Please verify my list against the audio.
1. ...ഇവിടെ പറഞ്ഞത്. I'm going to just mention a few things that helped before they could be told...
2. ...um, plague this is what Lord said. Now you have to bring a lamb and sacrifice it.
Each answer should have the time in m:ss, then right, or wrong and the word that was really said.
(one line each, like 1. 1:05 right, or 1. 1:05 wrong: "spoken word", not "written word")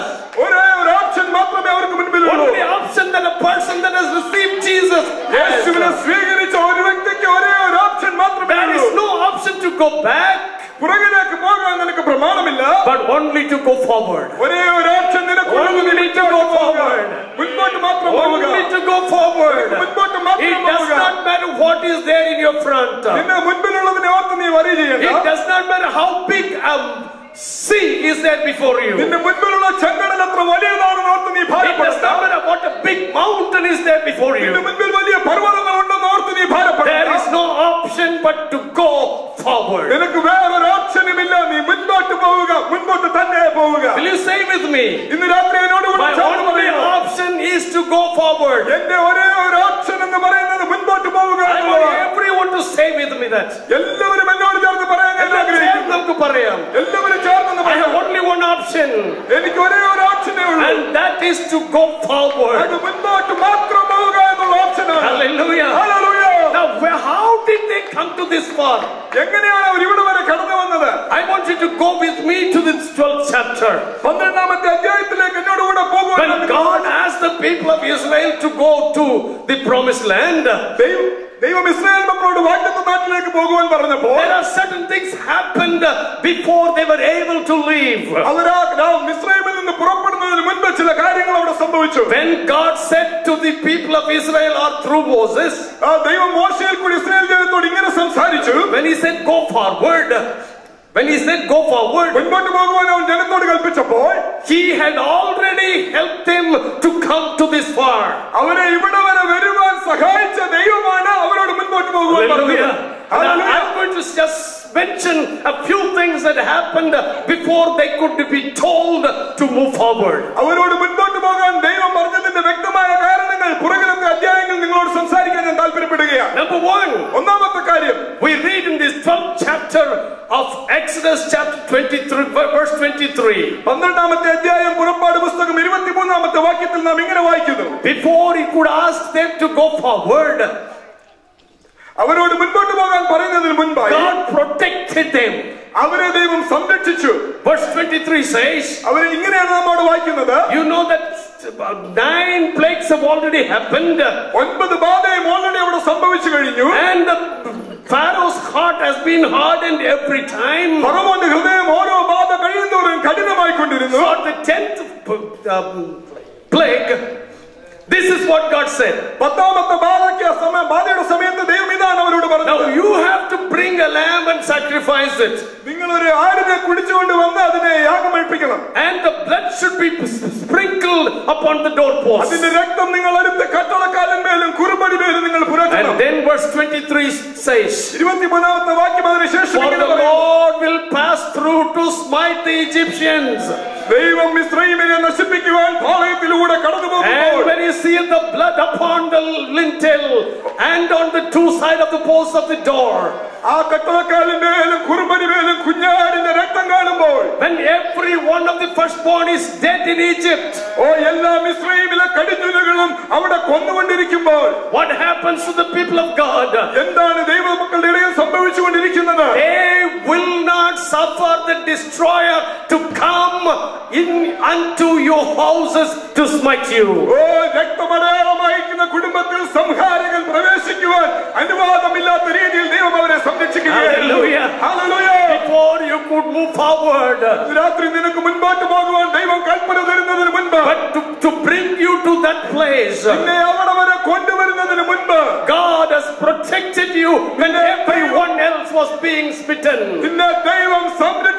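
1. 1:48 wrong: "happened", not "helped"
2. 2:45 wrong: "God", not "Lord".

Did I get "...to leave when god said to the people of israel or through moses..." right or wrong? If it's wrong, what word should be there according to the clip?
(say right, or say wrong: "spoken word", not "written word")
right.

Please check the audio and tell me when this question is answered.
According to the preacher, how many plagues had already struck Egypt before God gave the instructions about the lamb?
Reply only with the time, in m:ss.
2:31.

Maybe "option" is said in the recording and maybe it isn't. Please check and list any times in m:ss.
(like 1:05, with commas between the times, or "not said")
0:02, 0:09, 0:37, 0:46, 0:58.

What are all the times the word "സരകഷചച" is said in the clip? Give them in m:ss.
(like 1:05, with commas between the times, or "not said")
2:26.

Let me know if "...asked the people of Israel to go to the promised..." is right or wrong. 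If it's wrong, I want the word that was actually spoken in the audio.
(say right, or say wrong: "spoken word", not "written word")
right.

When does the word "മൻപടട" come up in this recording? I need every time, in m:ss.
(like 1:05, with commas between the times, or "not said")
2:22, 3:58.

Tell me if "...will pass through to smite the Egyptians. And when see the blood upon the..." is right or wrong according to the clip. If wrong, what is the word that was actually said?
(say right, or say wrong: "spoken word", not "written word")
right.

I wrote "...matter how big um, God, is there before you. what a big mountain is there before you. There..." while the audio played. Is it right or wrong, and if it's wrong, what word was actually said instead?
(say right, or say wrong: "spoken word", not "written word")
wrong: "See", not "God".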